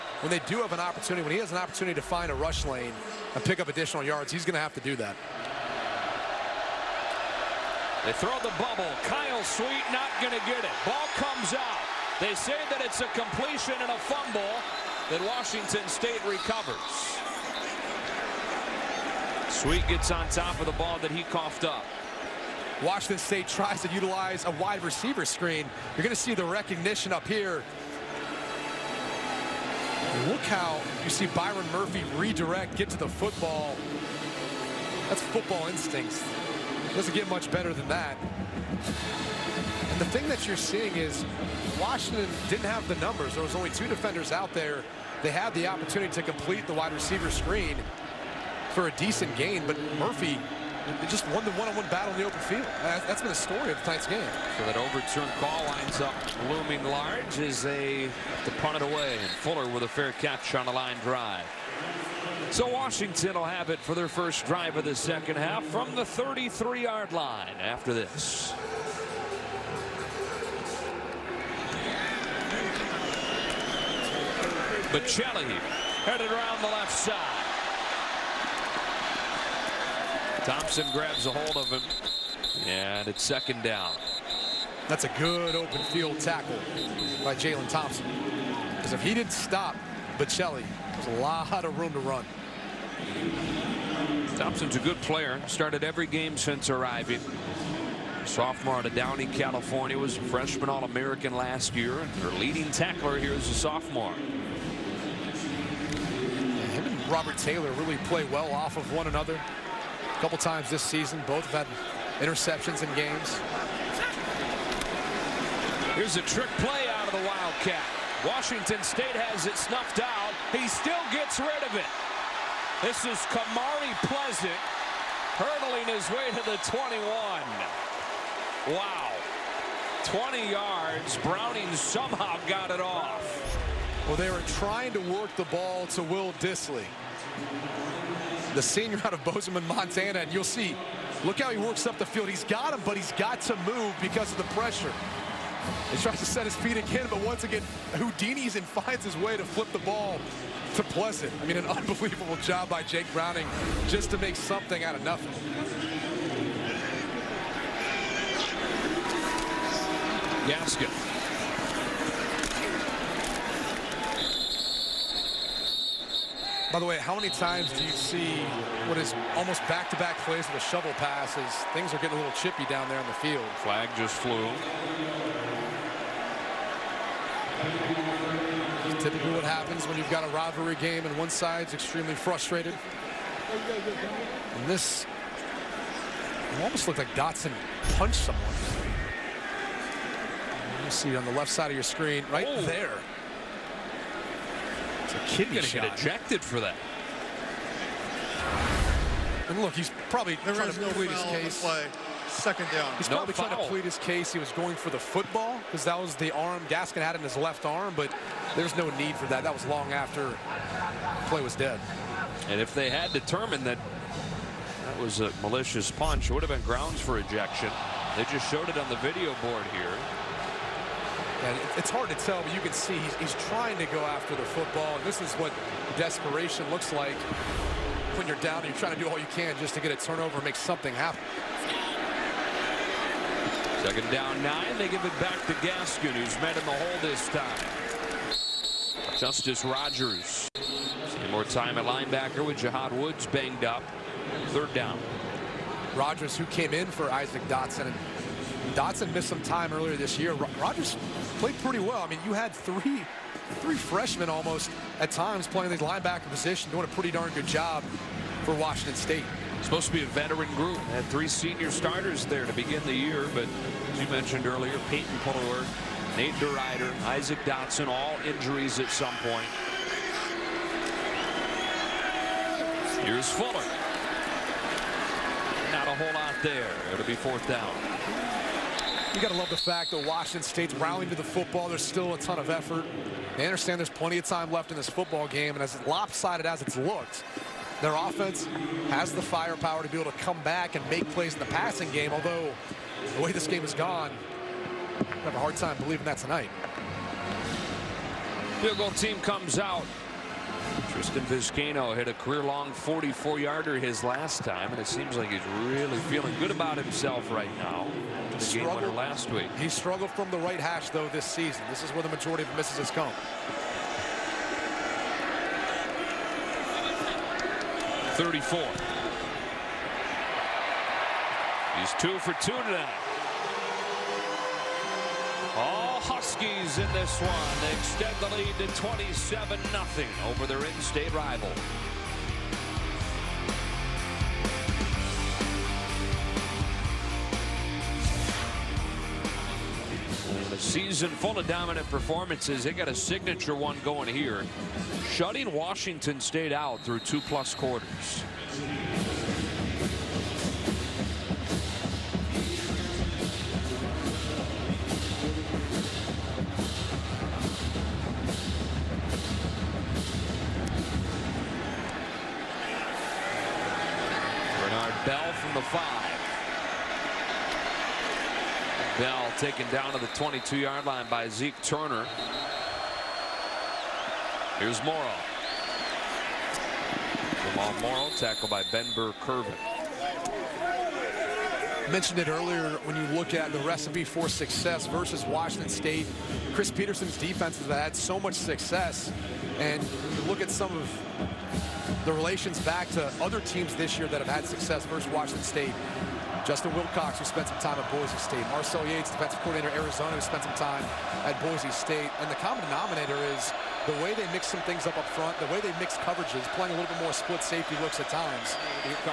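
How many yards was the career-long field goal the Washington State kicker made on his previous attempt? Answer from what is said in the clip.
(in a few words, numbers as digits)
44.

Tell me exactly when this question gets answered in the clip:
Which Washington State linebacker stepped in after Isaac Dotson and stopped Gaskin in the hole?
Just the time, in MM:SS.
03:59.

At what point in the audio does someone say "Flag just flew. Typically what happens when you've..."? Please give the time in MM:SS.
02:53.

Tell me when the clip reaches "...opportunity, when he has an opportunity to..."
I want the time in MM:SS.
00:00.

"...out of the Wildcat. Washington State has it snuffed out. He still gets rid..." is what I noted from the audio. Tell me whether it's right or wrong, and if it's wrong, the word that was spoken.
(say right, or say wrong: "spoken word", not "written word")
right.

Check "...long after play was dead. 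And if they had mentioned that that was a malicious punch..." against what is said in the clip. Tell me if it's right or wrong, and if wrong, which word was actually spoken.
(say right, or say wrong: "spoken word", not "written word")
wrong: "determined", not "mentioned".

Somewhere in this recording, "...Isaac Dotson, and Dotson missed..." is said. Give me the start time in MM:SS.
04:07.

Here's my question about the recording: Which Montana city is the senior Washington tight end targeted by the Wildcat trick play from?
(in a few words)
Bozeman.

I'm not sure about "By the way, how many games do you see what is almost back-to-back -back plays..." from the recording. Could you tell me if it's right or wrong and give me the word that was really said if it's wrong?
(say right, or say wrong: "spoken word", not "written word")
wrong: "times", not "games".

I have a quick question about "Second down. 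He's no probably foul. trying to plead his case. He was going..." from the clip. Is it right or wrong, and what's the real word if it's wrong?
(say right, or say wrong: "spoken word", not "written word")
right.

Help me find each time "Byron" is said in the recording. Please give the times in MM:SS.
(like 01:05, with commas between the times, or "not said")
00:31.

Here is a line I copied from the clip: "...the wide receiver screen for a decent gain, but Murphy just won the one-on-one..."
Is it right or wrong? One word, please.
right.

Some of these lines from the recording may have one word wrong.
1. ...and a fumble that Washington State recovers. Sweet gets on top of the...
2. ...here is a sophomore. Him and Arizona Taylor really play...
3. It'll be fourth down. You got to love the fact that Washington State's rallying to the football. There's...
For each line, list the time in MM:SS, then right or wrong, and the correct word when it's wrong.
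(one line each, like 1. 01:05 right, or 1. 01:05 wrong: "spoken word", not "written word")
1. 00:13 right
2. 01:43 wrong: "Robert", not "Arizona"
3. 04:36 right.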